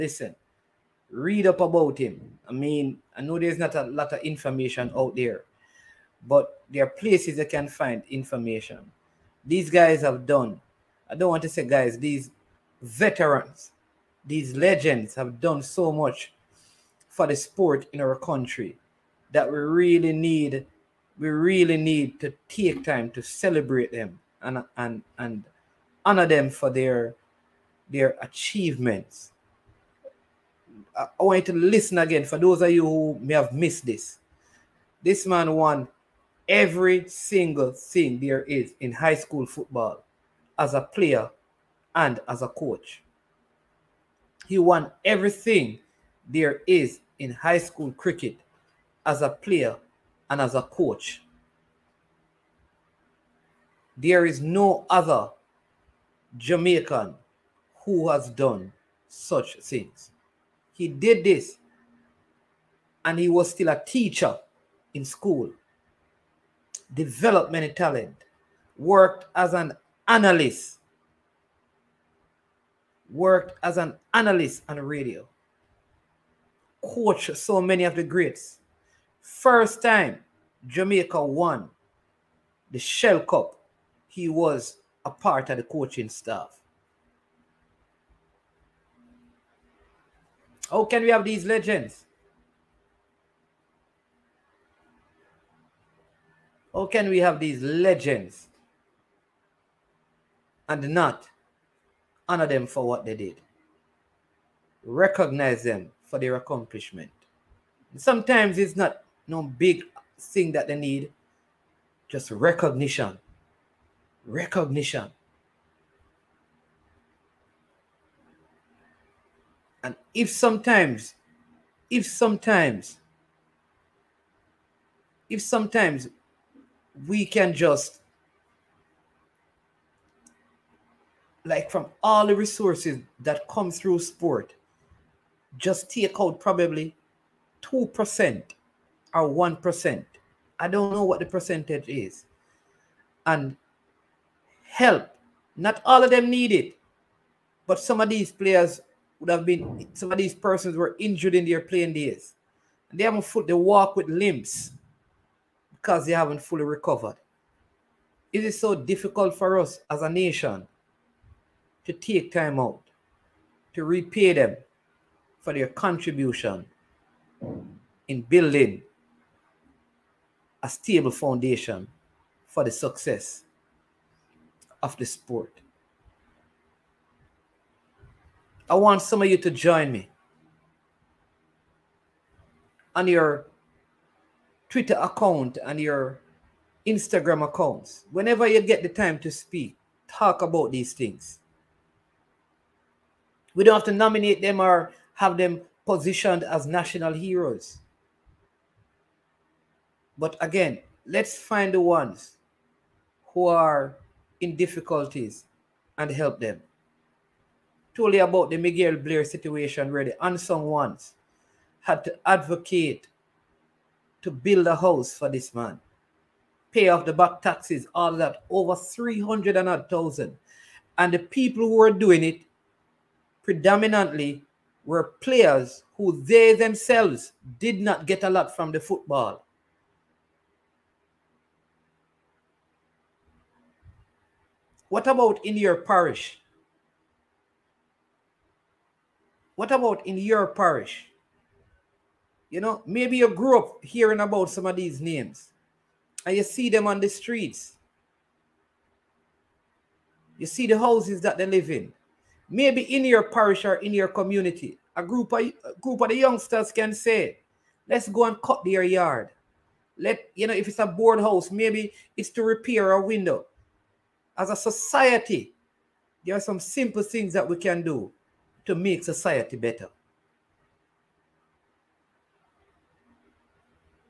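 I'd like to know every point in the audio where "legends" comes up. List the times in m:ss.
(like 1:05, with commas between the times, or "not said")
0:14, 1:31, 1:37.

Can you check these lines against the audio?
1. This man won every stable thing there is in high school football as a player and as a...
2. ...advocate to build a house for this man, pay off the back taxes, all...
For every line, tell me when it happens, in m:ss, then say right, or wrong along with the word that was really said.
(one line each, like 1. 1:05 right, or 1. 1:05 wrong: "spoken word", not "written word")
1. 0:35 wrong: "single", not "stable"
2. 3:32 right.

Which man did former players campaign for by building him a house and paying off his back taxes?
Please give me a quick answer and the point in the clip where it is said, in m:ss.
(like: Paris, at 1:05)
Miguel Blair, at 3:28.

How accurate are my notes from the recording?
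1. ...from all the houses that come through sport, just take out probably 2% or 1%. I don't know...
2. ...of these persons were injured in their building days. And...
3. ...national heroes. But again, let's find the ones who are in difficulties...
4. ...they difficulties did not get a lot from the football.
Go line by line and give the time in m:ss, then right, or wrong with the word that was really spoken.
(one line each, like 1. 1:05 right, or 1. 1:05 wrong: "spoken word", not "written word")
1. 2:11 wrong: "resources", not "houses"
2. 2:30 wrong: "playing", not "building"
3. 3:16 right
4. 3:46 wrong: "themselves", not "difficulties".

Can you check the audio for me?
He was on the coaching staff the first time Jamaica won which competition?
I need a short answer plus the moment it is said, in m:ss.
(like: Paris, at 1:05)
Shell Cup, at 1:22.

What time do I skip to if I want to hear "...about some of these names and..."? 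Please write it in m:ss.
4:04.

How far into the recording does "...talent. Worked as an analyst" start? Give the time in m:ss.
1:07.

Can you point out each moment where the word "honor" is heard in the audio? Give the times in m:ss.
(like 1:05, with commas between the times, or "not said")
0:26, 1:42.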